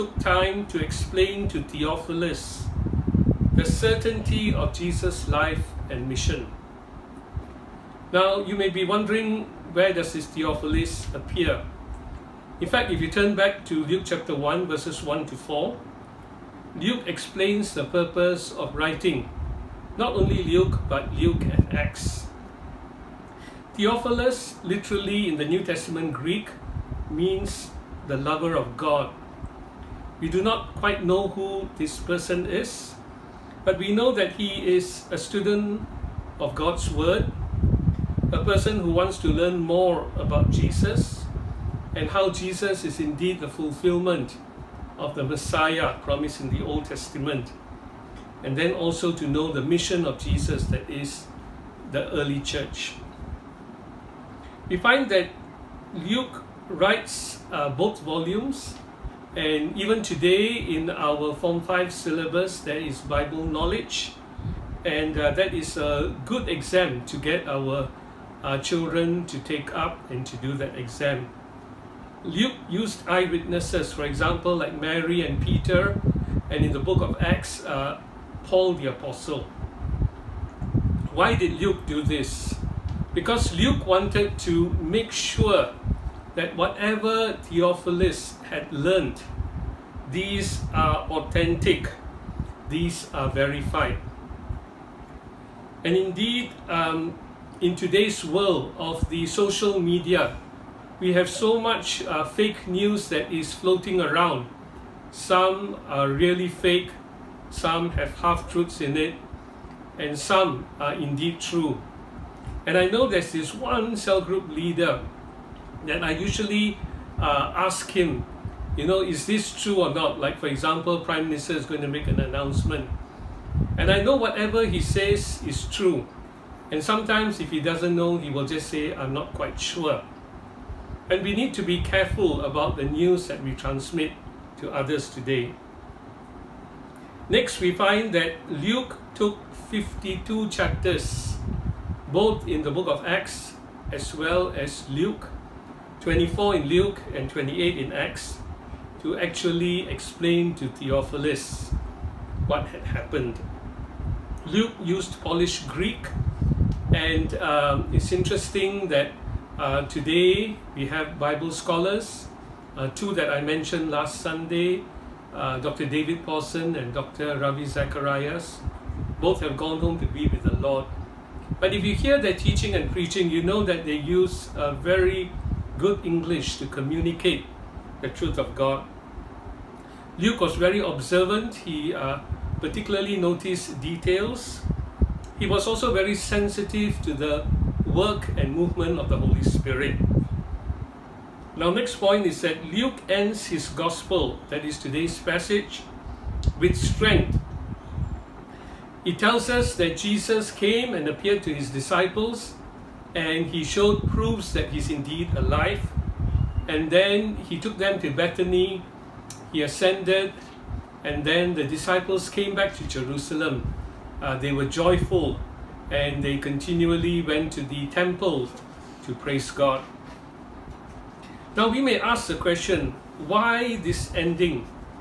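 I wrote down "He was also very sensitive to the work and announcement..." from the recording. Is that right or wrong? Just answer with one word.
wrong.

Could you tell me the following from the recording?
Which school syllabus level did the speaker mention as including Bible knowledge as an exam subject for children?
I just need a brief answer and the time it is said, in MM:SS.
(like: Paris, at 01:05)
Form 5, at 01:01.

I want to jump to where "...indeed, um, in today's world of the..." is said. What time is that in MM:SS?
01:35.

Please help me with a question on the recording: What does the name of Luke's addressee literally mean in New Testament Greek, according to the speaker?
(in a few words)
the lover of God.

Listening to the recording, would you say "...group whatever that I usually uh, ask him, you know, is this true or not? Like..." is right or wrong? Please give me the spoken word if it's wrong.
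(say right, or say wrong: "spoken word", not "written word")
wrong: "leader", not "whatever".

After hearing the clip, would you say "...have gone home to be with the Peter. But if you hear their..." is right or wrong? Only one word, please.
wrong.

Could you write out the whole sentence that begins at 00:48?
And then also to know the mission of Jesus that is the early church.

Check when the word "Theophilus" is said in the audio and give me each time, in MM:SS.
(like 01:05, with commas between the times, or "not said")
00:01, 00:10, 00:23, 01:27, 02:30.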